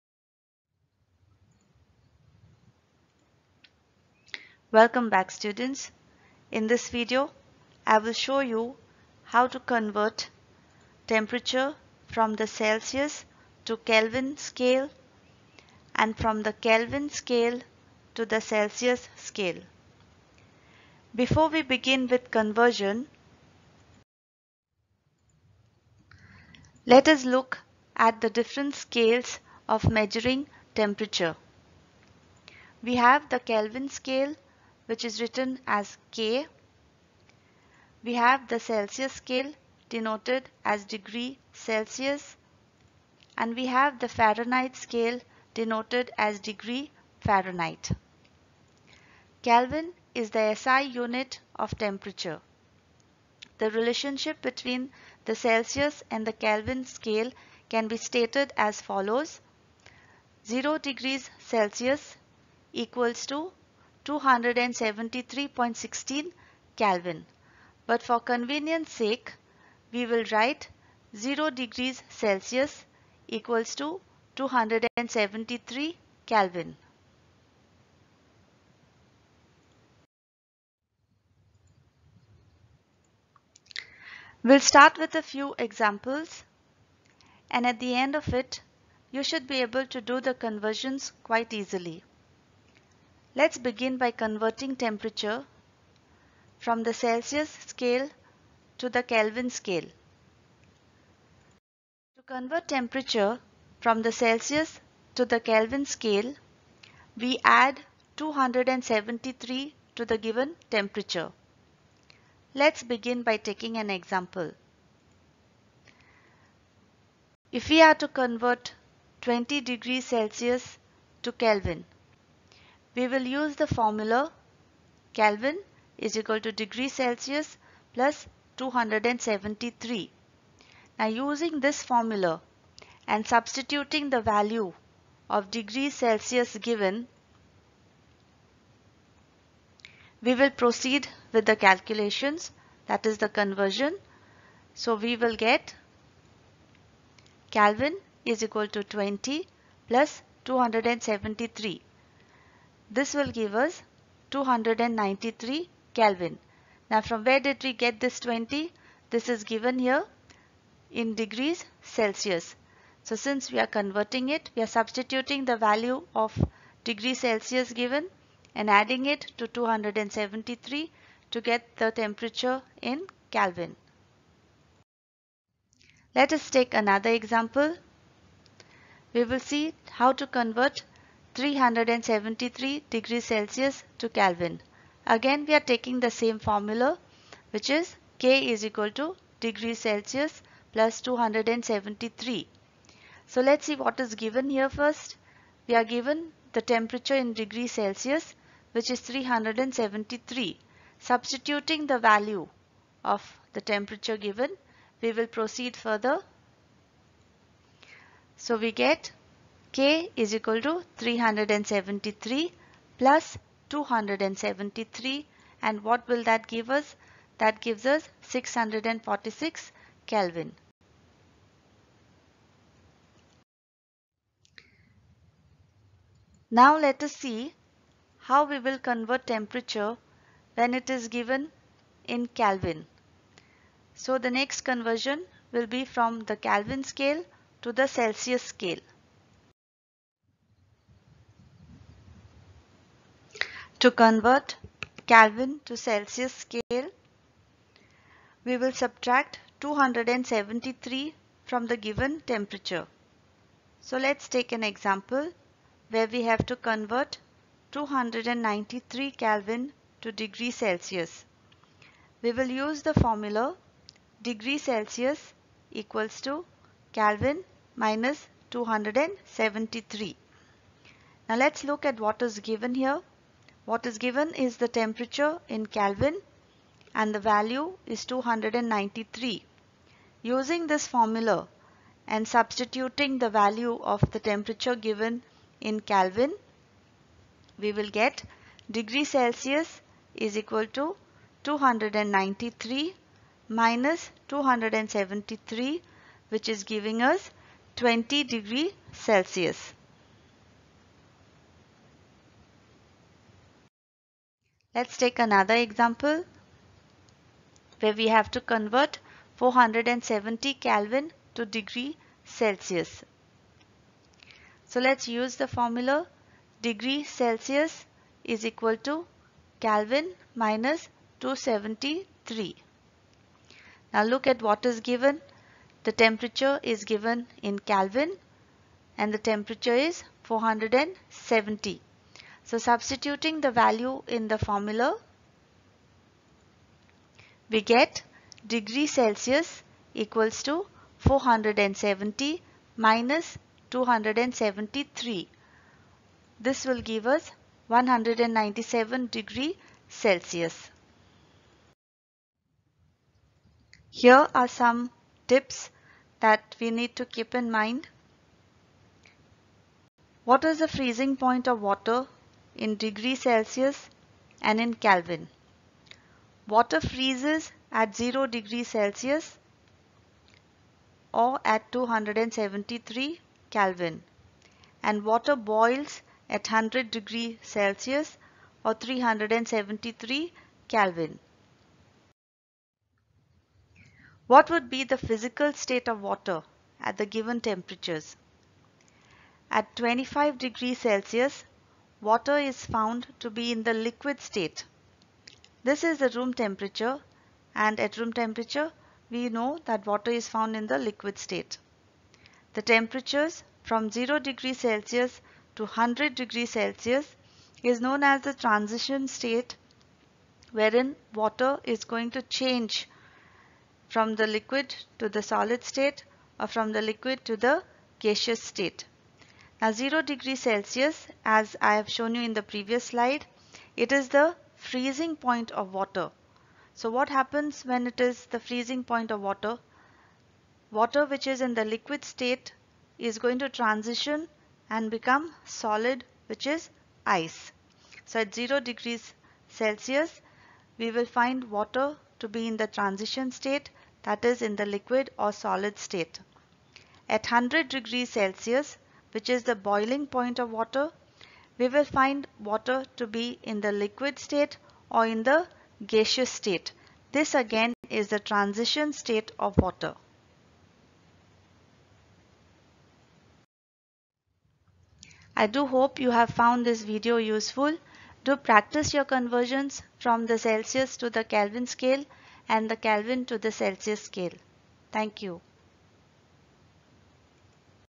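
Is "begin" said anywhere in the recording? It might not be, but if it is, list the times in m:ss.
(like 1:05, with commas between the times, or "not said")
0:21, 1:33, 1:52.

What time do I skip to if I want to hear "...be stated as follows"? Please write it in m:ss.
0:57.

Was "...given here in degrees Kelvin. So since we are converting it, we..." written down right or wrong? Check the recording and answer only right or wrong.
wrong.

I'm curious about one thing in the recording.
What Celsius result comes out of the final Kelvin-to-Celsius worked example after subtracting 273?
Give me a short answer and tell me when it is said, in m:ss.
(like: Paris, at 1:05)
197 °C, at 5:47.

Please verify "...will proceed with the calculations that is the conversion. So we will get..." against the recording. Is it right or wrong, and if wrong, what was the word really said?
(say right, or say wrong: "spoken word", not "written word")
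right.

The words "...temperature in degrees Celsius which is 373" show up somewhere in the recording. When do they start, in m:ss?
3:16.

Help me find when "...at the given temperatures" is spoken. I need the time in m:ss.
6:26.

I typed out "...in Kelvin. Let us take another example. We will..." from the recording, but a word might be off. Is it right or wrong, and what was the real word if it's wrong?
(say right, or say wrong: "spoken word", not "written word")
right.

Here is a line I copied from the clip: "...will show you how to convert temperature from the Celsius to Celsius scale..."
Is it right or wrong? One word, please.
wrong.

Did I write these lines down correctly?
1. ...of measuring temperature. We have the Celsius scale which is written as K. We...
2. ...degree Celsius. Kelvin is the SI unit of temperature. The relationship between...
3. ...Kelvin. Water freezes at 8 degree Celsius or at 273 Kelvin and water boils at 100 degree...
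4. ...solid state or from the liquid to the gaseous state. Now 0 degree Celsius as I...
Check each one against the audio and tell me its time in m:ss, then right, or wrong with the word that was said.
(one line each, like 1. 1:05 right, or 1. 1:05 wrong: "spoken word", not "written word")
1. 0:29 wrong: "Kelvin", not "Celsius"
2. 0:46 wrong: "Fahrenheit", not "Celsius"
3. 6:04 wrong: "0", not "8"
4. 6:55 right.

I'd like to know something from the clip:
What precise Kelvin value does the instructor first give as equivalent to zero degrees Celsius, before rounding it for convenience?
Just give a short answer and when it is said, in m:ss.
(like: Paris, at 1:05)
273.16 K, at 1:04.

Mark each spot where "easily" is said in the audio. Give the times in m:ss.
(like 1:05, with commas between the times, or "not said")
1:31.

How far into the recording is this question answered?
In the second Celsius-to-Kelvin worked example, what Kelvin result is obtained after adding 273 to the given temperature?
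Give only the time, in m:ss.
3:38.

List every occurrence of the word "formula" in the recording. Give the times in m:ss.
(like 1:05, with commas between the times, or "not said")
2:03, 2:11, 3:06, 4:22, 4:40, 5:15, 5:34.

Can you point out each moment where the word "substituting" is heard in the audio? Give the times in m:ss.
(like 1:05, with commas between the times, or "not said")
2:13, 2:44, 3:20, 4:42, 5:32.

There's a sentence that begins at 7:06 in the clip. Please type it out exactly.
So what happens when it is the freezing point of water?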